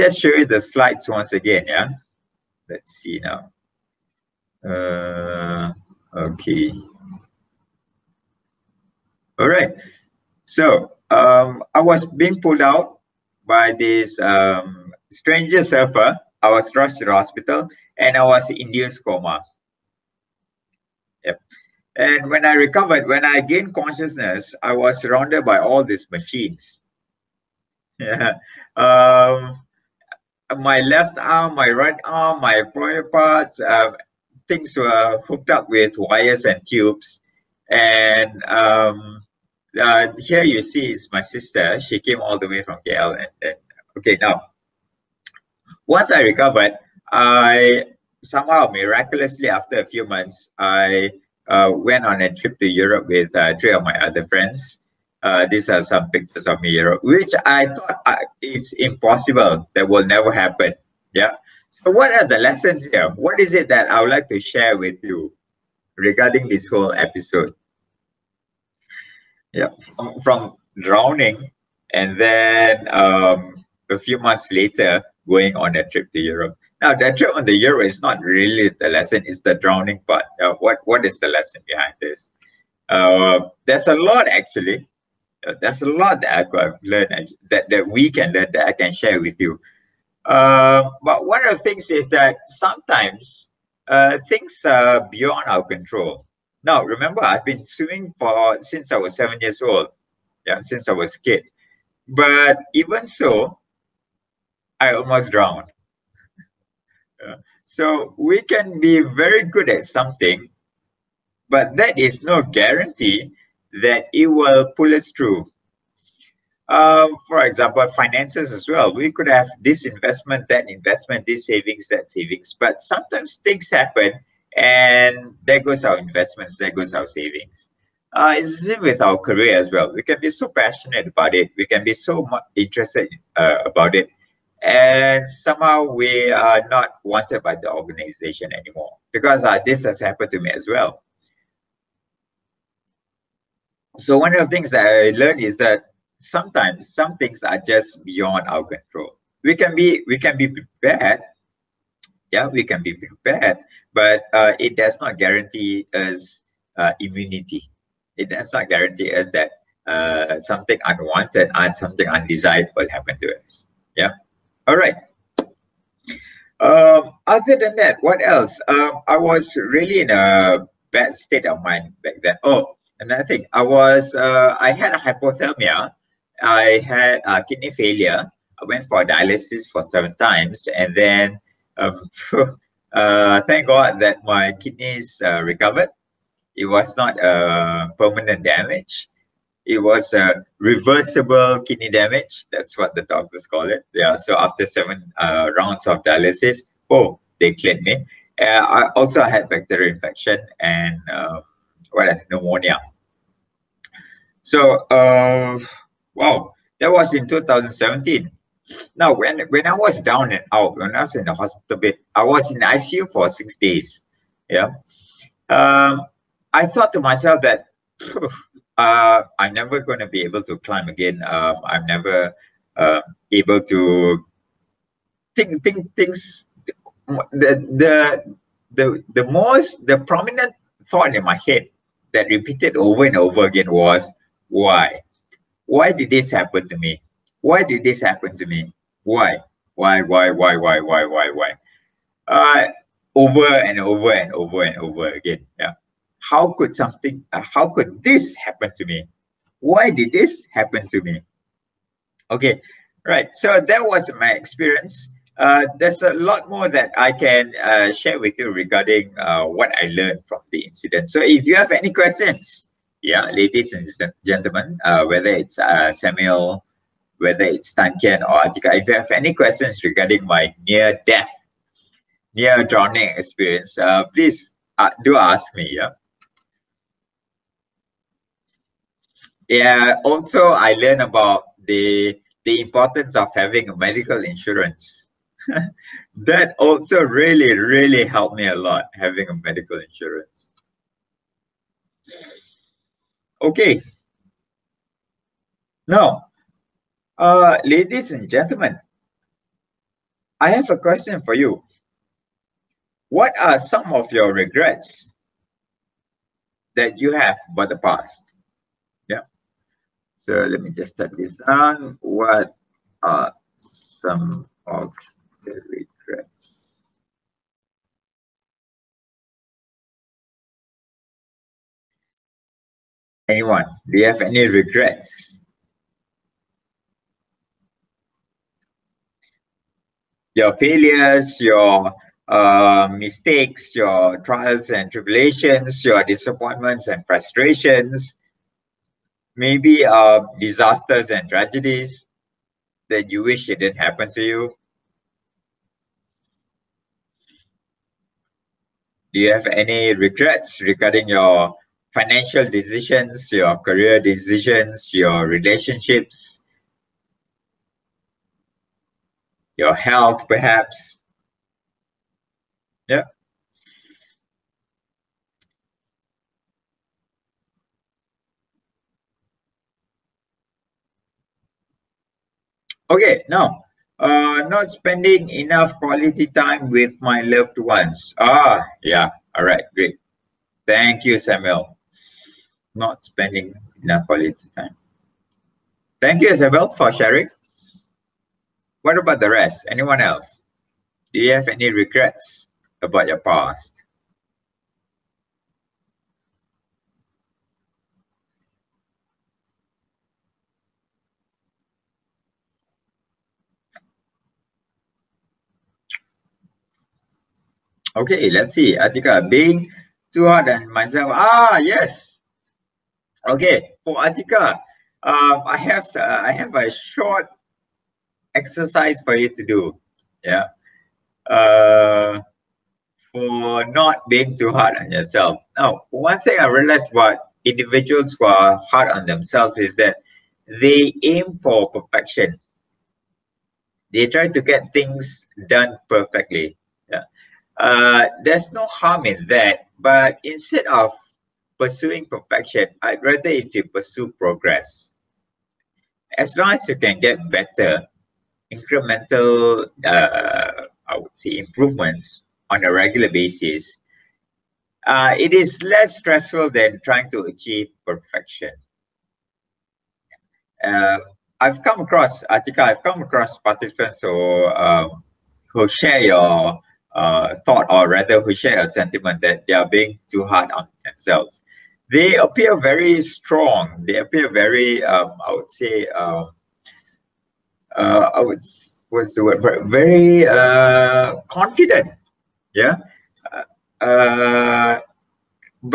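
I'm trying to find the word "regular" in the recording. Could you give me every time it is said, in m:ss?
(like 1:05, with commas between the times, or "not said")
7:32.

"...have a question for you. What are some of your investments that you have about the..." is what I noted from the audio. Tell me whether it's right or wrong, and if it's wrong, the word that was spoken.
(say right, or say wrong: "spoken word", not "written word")
wrong: "regrets", not "investments".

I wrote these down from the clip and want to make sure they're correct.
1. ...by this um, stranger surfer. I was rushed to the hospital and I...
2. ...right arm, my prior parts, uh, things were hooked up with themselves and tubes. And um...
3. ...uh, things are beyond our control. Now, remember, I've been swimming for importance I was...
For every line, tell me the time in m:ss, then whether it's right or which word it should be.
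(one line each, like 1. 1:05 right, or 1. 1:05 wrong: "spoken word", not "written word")
1. 0:13 right
2. 0:31 wrong: "wires", not "themselves"
3. 1:33 wrong: "since", not "importance".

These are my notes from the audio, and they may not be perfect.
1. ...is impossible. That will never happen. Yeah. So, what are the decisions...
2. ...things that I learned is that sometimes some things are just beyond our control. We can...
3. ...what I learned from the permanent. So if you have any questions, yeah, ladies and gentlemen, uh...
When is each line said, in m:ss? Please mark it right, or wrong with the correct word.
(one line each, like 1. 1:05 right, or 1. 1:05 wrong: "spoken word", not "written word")
1. 0:58 wrong: "lessons", not "decisions"
2. 2:24 right
3. 4:19 wrong: "incident", not "permanent".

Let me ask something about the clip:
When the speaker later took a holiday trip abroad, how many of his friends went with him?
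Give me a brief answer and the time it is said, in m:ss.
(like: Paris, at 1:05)
3, at 0:53.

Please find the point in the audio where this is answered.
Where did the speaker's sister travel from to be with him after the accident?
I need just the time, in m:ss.
0:42.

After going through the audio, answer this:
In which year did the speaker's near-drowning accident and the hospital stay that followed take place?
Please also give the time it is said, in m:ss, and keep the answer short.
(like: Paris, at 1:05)
2017, at 3:27.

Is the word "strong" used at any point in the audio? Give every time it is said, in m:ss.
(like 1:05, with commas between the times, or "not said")
7:53.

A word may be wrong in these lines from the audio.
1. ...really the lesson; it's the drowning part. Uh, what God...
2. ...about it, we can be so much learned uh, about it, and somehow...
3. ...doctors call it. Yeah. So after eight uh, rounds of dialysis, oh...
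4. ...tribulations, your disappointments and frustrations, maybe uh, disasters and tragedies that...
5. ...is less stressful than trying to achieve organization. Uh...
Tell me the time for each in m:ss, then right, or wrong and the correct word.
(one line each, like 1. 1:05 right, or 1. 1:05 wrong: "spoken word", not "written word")
1. 1:18 wrong: "What", not "God"
2. 2:11 wrong: "interested", not "learned"
3. 3:13 wrong: "seven", not "eight"
4. 5:34 right
5. 7:35 wrong: "perfection", not "organization".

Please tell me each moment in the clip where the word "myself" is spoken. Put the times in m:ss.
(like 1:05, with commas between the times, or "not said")
3:37, 6:50.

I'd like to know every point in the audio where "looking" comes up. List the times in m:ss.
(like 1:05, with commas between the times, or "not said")
not said.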